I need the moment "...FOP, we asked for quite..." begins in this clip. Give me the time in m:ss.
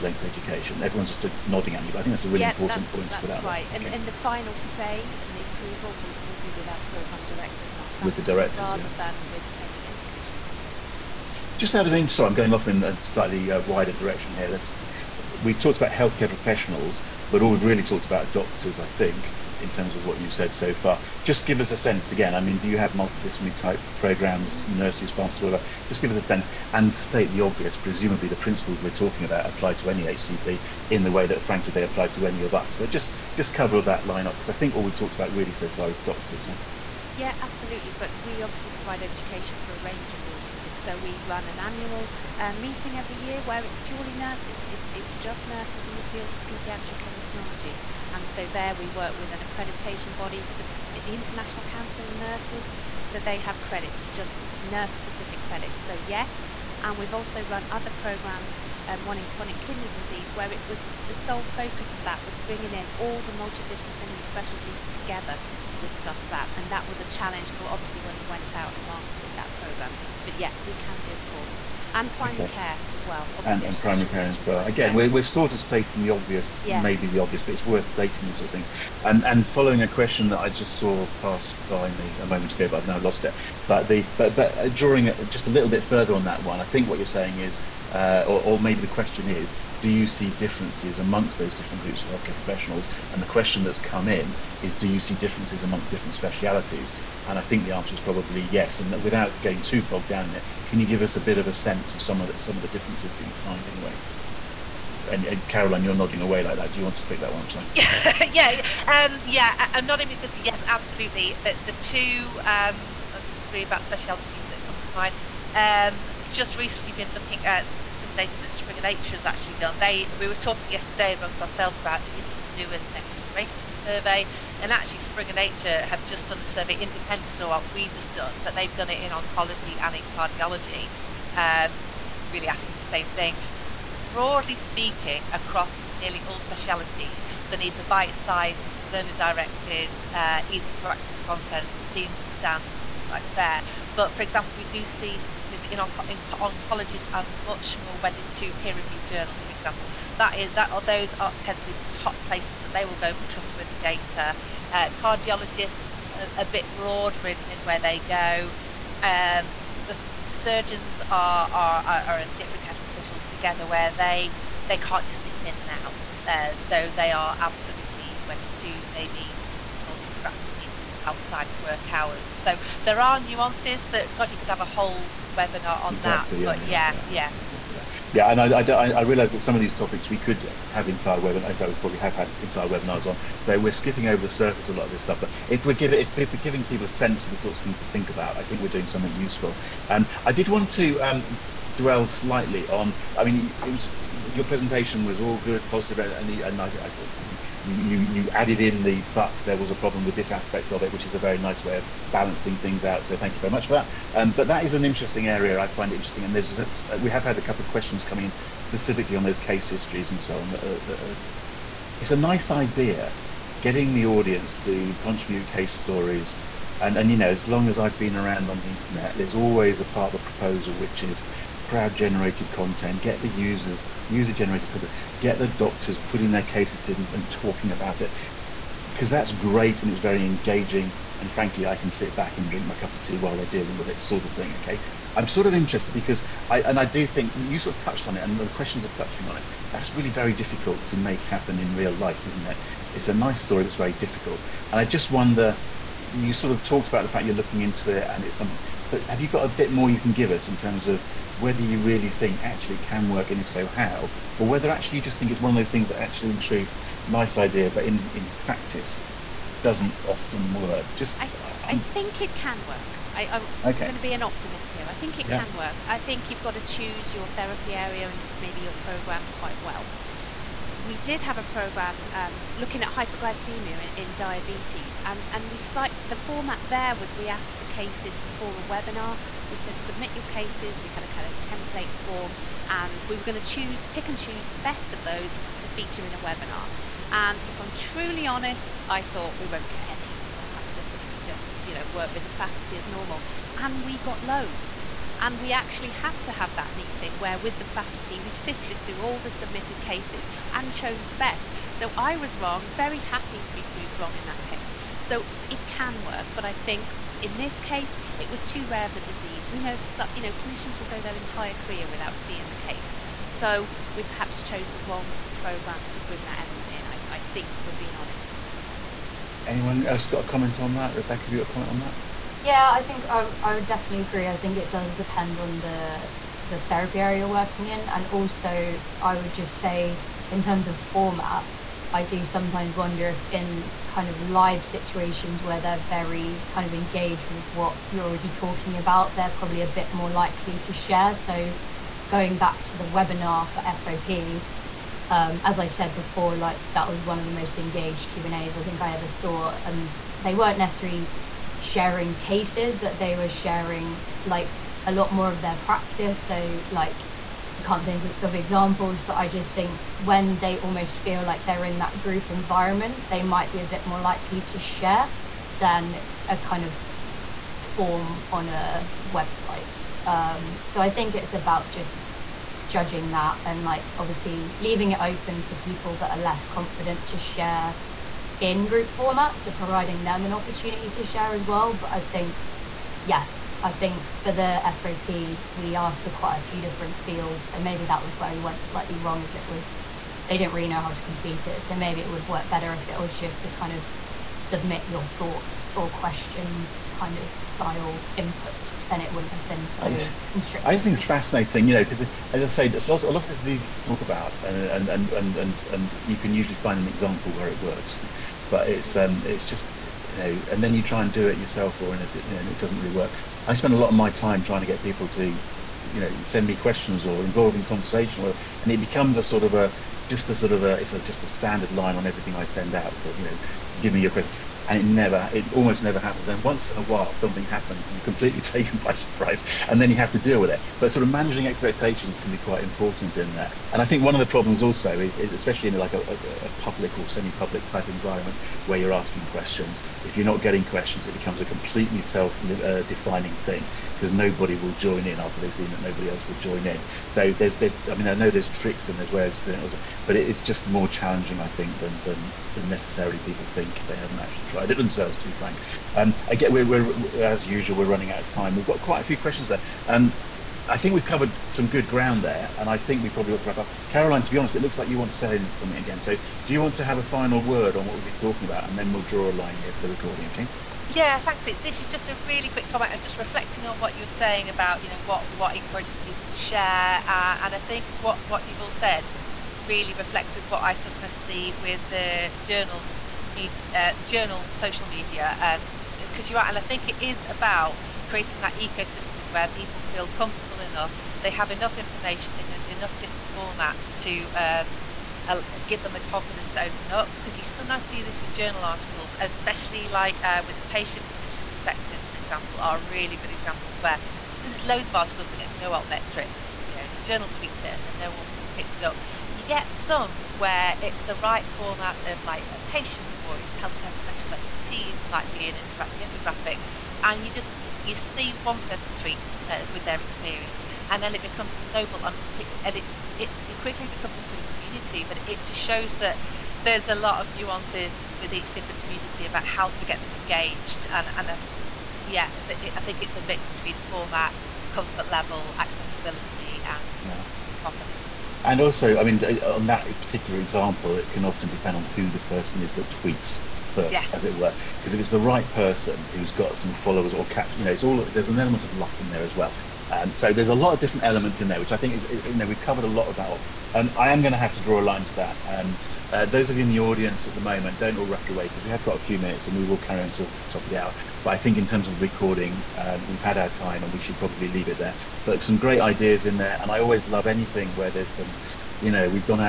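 6:24.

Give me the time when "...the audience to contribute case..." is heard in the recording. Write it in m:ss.
3:33.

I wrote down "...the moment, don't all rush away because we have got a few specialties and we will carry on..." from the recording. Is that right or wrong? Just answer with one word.
wrong.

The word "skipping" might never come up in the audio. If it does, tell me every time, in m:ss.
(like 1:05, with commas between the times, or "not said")
3:03.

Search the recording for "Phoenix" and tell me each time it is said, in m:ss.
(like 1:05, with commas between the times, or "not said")
not said.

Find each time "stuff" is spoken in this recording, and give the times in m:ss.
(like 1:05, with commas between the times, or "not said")
3:05.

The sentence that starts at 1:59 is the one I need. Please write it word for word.
They we were talking yesterday amongst ourselves about do we need to do it the next iteration of the survey?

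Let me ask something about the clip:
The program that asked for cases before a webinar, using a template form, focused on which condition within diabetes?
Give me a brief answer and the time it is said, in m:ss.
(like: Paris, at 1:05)
hyperglycemia, at 4:32.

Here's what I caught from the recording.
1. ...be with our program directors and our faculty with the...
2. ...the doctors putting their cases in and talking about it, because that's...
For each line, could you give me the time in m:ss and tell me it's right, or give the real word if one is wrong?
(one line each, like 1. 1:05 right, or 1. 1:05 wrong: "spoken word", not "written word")
1. 0:06 right
2. 3:45 right.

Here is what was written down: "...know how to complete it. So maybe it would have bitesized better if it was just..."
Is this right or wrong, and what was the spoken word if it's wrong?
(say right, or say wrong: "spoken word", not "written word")
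wrong: "worked", not "bitesized".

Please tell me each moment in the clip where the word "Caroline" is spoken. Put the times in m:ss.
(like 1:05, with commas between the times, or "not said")
1:45, 7:43.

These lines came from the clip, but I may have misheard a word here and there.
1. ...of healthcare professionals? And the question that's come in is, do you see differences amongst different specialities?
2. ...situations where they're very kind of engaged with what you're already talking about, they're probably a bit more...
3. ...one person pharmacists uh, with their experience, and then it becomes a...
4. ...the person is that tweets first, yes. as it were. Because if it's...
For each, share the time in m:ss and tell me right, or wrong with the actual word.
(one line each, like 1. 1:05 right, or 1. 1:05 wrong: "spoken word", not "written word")
1. 1:32 right
2. 5:34 right
3. 8:38 wrong: "tweets", not "pharmacists"
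4. 9:02 right.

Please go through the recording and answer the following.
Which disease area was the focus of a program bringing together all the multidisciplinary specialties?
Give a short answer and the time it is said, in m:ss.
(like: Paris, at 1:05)
chronic kidney disease, at 0:59.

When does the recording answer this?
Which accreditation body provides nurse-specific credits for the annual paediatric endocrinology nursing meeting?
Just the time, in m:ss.
0:51.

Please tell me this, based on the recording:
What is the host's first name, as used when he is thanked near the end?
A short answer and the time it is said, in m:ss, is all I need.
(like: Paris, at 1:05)
Pete, at 7:51.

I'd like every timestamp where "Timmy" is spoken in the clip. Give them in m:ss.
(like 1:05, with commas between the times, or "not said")
not said.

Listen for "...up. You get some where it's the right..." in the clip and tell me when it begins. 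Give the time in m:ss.
8:28.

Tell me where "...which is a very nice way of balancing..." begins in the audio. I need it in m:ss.
3:20.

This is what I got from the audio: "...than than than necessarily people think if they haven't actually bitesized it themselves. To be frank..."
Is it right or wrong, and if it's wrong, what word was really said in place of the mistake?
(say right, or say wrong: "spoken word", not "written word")
wrong: "tried", not "bitesized".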